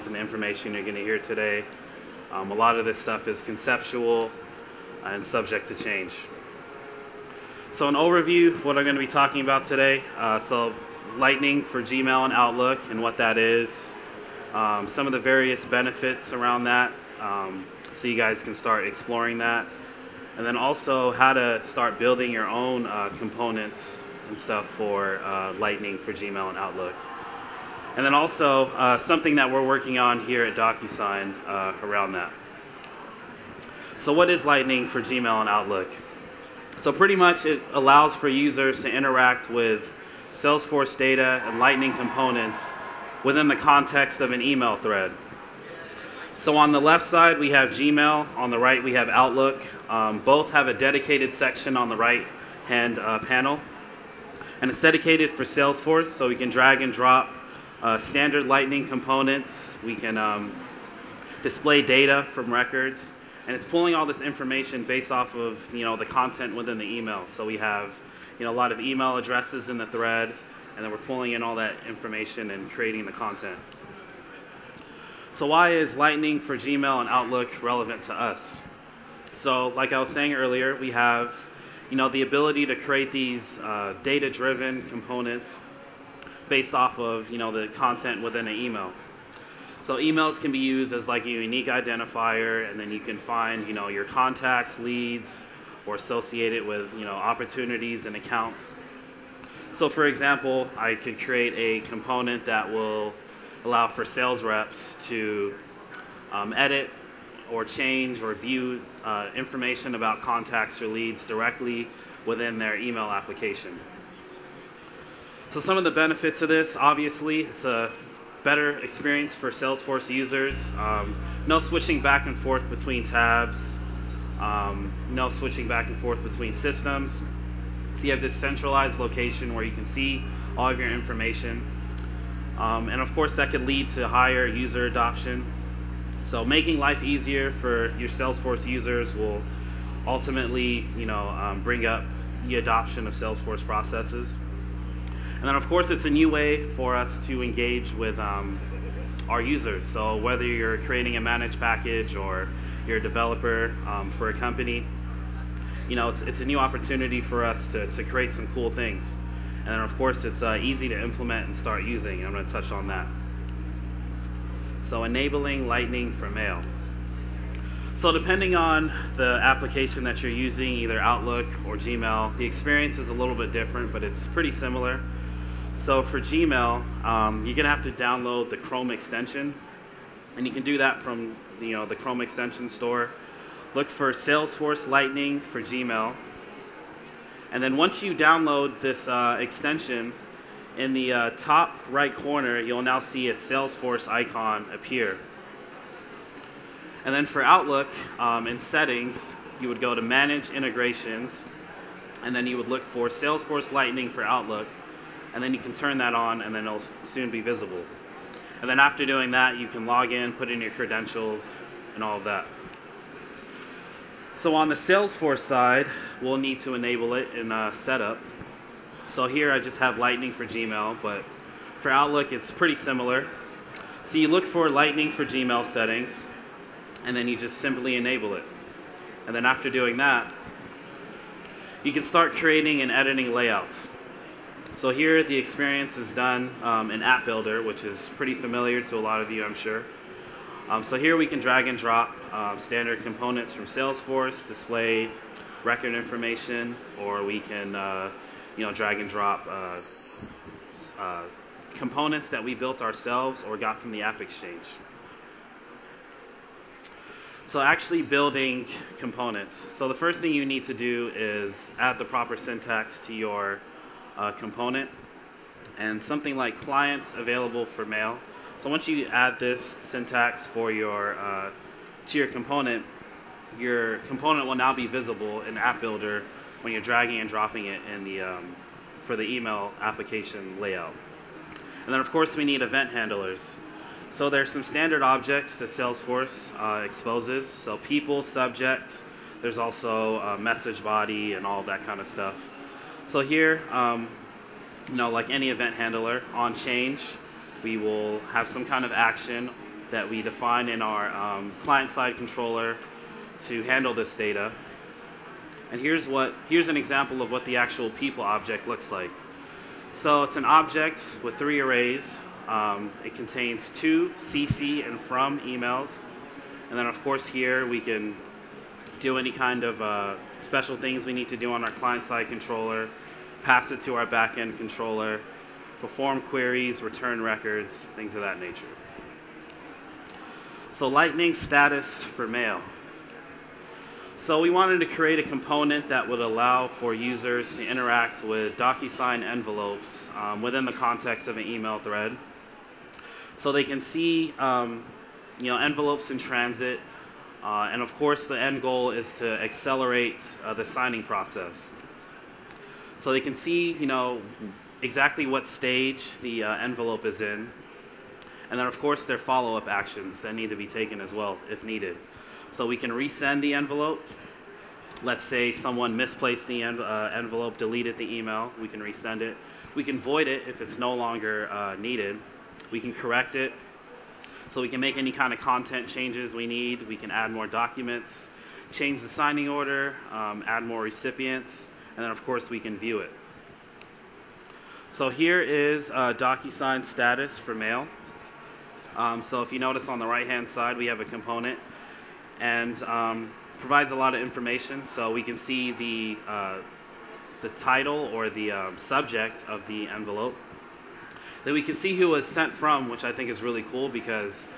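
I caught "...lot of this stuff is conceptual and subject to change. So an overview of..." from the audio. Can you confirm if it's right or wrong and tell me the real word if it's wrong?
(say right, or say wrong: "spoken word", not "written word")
right.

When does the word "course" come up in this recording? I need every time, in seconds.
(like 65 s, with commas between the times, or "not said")
133 s, 145 s, 159 s, 282 s, 317 s, 347 s, 358 s, 382 s.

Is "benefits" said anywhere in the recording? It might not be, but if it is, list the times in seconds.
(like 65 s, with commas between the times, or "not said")
15 s, 115 s.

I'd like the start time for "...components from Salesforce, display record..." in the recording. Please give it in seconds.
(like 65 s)
243 s.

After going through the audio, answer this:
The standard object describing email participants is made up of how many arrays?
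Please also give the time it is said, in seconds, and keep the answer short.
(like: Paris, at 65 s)
3, at 311 s.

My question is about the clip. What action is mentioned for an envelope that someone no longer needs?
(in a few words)
void it.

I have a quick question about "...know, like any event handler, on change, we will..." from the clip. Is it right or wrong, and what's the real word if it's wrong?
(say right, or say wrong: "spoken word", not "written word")
right.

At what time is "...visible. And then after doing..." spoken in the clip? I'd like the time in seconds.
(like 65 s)
207 s.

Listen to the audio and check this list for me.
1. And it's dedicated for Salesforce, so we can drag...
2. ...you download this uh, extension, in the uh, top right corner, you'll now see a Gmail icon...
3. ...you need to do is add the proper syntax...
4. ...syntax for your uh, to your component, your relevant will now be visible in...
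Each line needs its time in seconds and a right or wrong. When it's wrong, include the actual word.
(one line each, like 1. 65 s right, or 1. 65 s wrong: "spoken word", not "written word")
1. 54 s right
2. 188 s wrong: "Salesforce", not "Gmail"
3. 260 s right
4. 269 s wrong: "component", not "relevant".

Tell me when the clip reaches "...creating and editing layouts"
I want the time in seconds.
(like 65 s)
232 s.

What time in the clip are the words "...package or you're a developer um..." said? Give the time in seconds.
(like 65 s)
151 s.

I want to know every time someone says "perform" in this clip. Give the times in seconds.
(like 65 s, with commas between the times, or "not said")
325 s.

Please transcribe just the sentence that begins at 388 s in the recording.
Um, so if you notice on the right-hand side, we have a component and um, provides a lot of information.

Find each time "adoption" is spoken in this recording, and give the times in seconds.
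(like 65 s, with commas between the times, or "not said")
134 s, 142 s.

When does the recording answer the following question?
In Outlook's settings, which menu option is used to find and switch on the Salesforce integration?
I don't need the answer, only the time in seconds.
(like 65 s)
200 s.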